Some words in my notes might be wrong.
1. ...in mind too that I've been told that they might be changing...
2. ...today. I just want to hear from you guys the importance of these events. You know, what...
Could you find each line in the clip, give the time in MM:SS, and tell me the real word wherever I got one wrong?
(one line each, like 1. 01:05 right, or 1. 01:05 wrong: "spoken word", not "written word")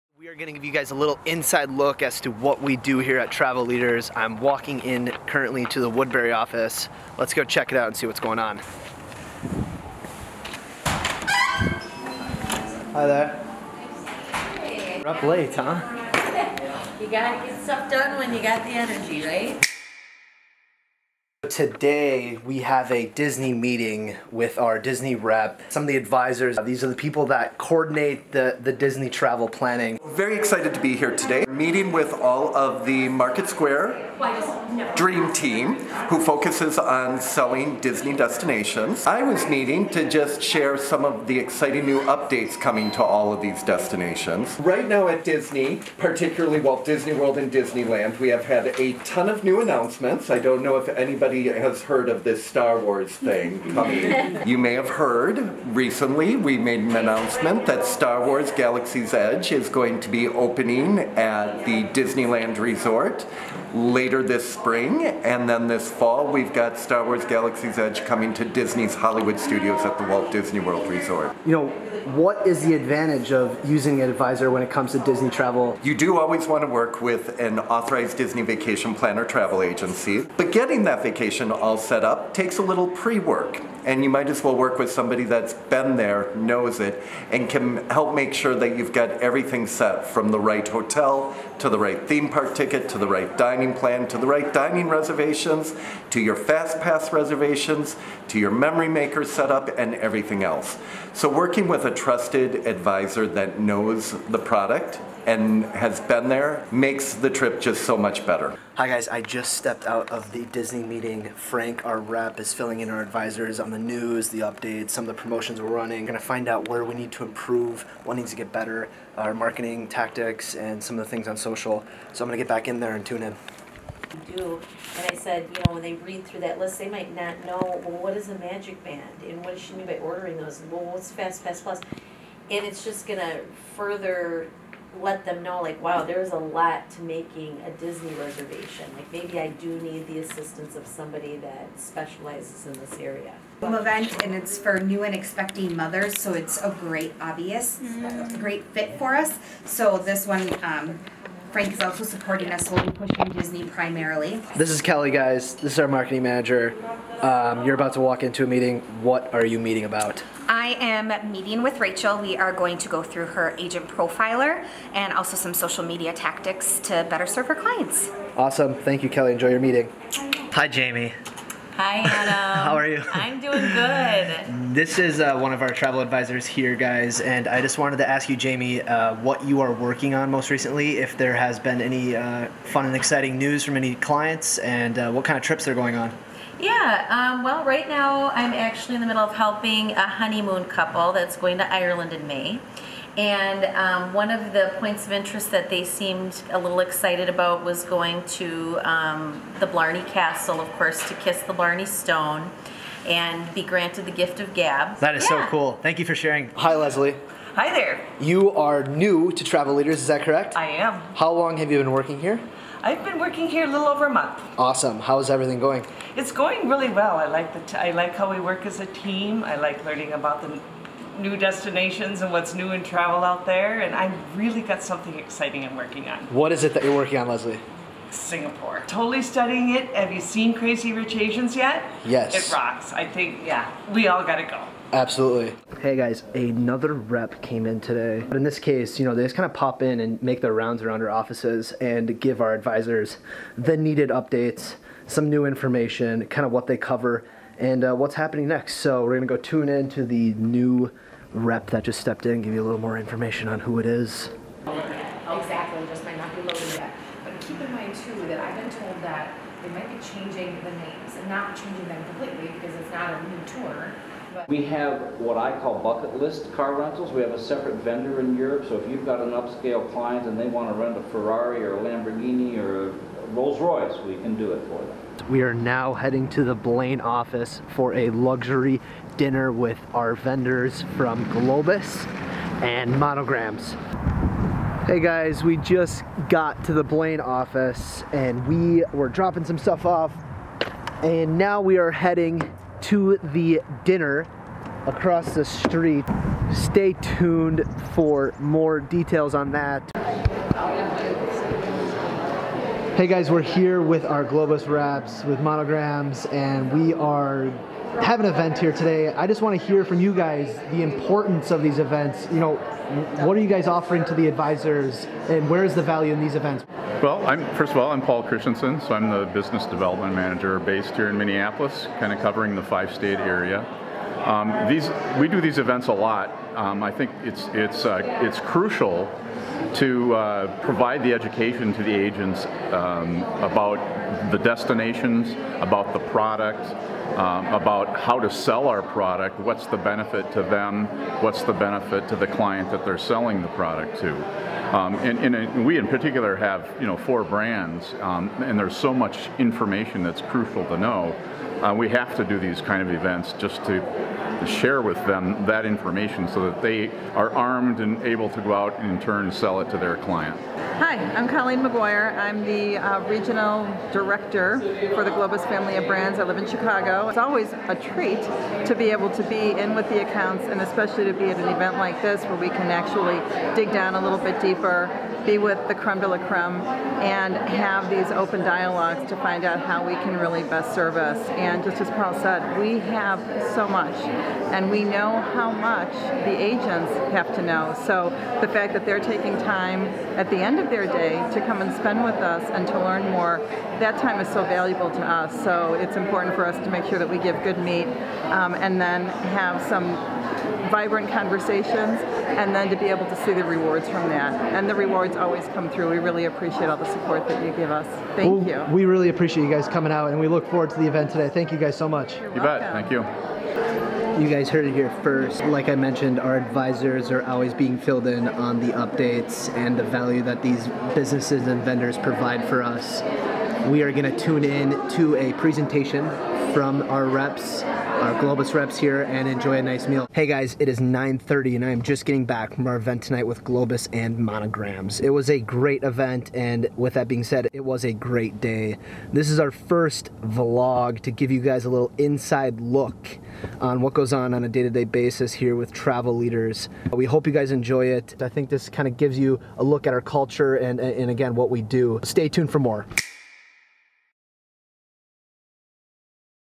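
1. 04:17 right
2. 05:08 right.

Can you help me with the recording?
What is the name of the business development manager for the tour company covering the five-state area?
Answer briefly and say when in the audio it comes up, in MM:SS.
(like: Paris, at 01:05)
Paul Christensen, at 05:18.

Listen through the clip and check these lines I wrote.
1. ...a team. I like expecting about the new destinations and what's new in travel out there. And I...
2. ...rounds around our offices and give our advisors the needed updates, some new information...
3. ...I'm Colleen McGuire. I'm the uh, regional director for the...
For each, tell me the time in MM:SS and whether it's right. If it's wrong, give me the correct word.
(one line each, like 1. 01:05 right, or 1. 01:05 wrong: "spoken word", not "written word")
1. 03:38 wrong: "learning", not "expecting"
2. 04:00 right
3. 06:01 right.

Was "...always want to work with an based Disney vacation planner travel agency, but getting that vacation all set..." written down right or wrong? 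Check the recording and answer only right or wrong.
wrong.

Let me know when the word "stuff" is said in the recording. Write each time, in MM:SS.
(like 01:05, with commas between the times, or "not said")
00:17, 04:49.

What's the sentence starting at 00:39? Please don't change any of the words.
I was meeting to just share some of the exciting new updates coming to all of these destinations.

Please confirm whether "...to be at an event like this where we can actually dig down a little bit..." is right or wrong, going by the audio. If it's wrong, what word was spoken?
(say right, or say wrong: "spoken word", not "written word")
right.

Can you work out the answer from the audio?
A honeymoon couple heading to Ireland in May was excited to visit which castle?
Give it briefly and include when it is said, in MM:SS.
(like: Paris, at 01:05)
Blarney Castle, at 03:19.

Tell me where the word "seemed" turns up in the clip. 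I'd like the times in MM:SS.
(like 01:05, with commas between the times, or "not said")
03:15.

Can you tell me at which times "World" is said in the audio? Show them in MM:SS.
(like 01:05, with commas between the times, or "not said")
00:47, 01:10.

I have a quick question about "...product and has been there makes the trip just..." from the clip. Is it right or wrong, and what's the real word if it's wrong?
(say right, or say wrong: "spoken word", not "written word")
right.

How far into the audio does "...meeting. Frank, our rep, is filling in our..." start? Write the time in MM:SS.
01:50.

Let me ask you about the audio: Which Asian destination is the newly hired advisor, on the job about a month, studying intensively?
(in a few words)
Singapore.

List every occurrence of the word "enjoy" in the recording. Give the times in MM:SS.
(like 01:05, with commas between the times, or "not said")
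02:49, 07:09, 07:27.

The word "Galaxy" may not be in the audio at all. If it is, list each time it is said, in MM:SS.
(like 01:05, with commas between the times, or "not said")
00:58, 01:07.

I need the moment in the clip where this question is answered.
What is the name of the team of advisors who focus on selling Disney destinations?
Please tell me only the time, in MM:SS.
00:33.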